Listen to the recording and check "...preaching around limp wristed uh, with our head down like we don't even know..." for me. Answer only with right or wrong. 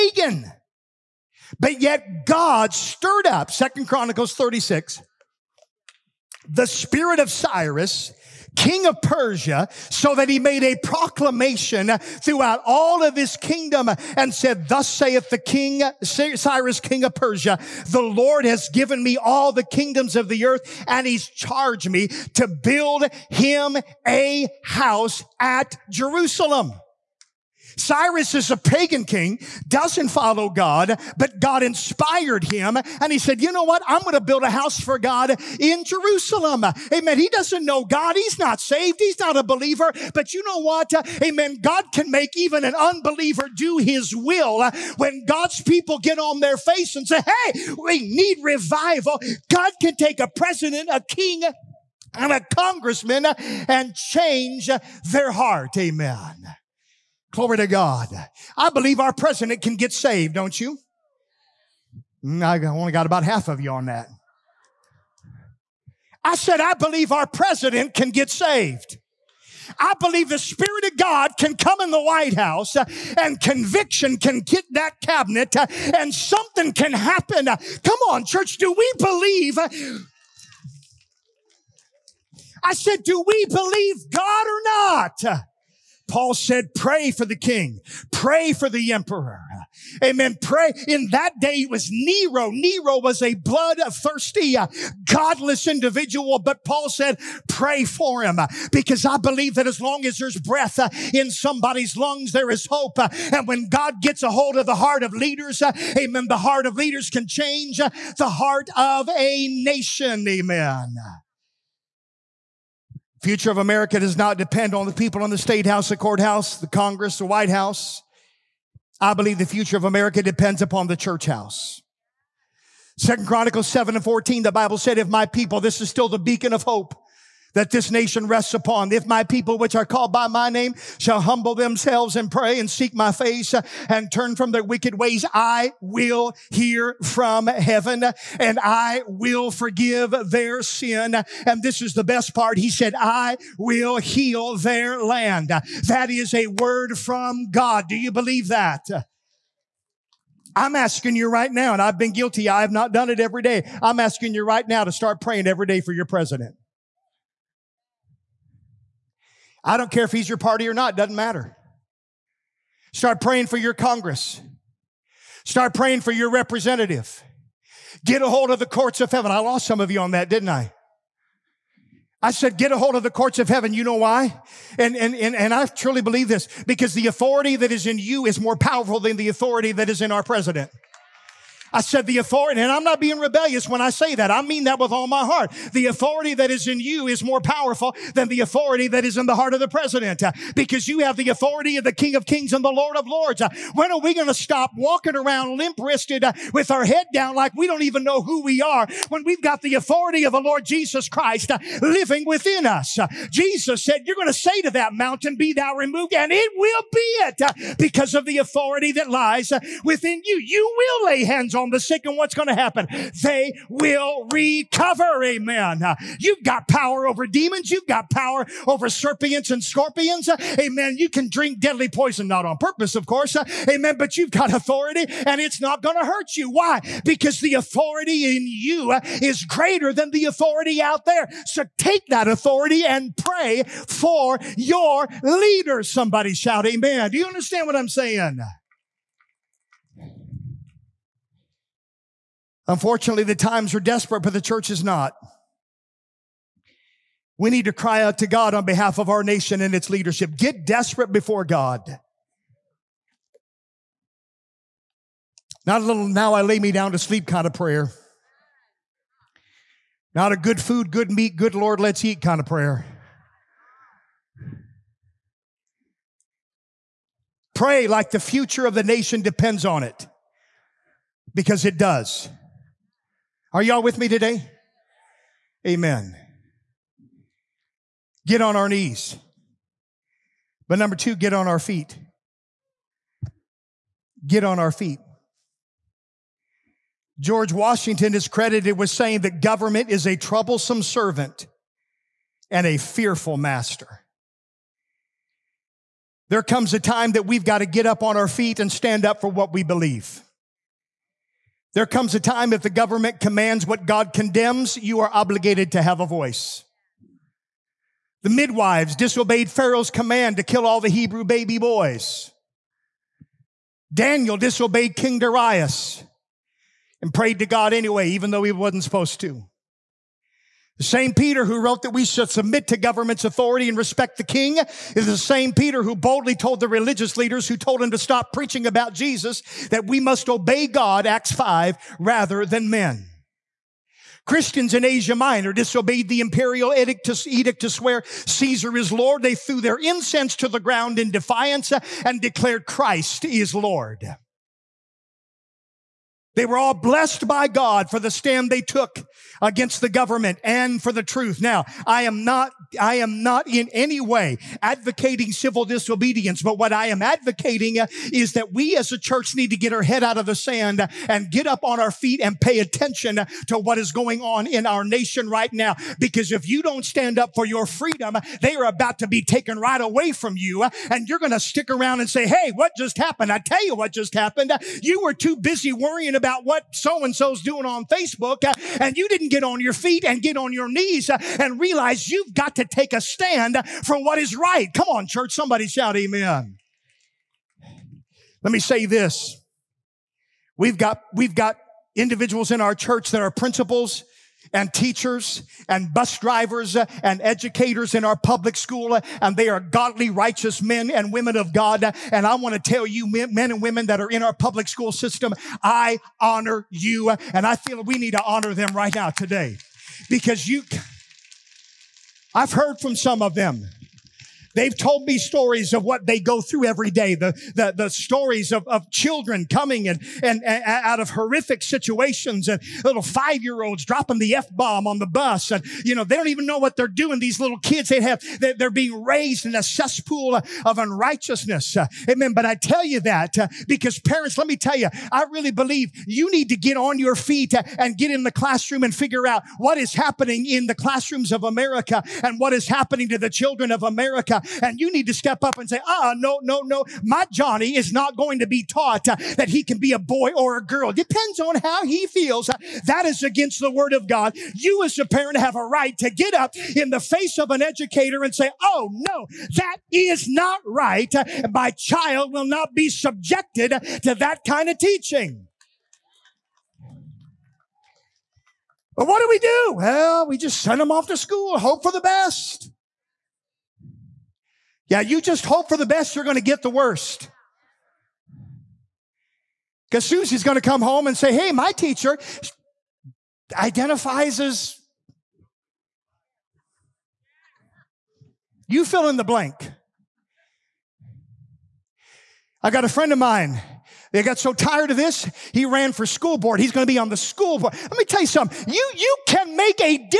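wrong.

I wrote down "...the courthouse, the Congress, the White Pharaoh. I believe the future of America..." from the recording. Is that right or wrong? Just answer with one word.
wrong.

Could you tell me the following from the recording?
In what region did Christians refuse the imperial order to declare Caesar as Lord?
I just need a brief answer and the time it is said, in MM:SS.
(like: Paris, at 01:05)
Asia Minor, at 05:34.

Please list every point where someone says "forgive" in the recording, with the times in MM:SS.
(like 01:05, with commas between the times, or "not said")
02:19.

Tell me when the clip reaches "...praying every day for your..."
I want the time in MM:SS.
02:35.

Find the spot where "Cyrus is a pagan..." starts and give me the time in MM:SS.
00:27.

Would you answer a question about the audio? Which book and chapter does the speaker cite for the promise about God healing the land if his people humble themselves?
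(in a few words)
Second Chronicles 7.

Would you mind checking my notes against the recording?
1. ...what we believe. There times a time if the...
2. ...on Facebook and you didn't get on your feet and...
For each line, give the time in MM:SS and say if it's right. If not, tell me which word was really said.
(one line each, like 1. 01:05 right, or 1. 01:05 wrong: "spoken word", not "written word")
1. 04:59 wrong: "comes", not "times"
2. 06:17 right.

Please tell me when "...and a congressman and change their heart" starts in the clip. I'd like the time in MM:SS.
00:52.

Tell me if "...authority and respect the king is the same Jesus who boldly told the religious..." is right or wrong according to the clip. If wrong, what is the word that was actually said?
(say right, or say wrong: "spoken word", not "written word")
wrong: "Peter", not "Jesus".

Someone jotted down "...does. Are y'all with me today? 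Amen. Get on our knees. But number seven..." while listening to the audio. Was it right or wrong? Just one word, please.
wrong.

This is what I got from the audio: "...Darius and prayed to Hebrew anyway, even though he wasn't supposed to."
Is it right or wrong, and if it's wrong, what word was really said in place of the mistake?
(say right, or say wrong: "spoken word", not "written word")
wrong: "God", not "Hebrew".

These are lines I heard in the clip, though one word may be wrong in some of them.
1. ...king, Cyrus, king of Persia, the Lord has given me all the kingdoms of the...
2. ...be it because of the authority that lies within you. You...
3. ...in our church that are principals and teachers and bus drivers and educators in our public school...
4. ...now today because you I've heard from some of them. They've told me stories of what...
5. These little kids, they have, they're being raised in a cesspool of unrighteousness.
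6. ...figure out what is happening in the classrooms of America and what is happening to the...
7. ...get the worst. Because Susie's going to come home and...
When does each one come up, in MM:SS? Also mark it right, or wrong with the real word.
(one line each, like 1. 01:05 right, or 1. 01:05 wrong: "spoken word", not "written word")
1. 00:15 right
2. 03:26 right
3. 06:32 right
4. 06:48 right
5. 07:07 right
6. 07:18 right
7. 07:56 right.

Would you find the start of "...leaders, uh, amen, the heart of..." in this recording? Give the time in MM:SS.
01:45.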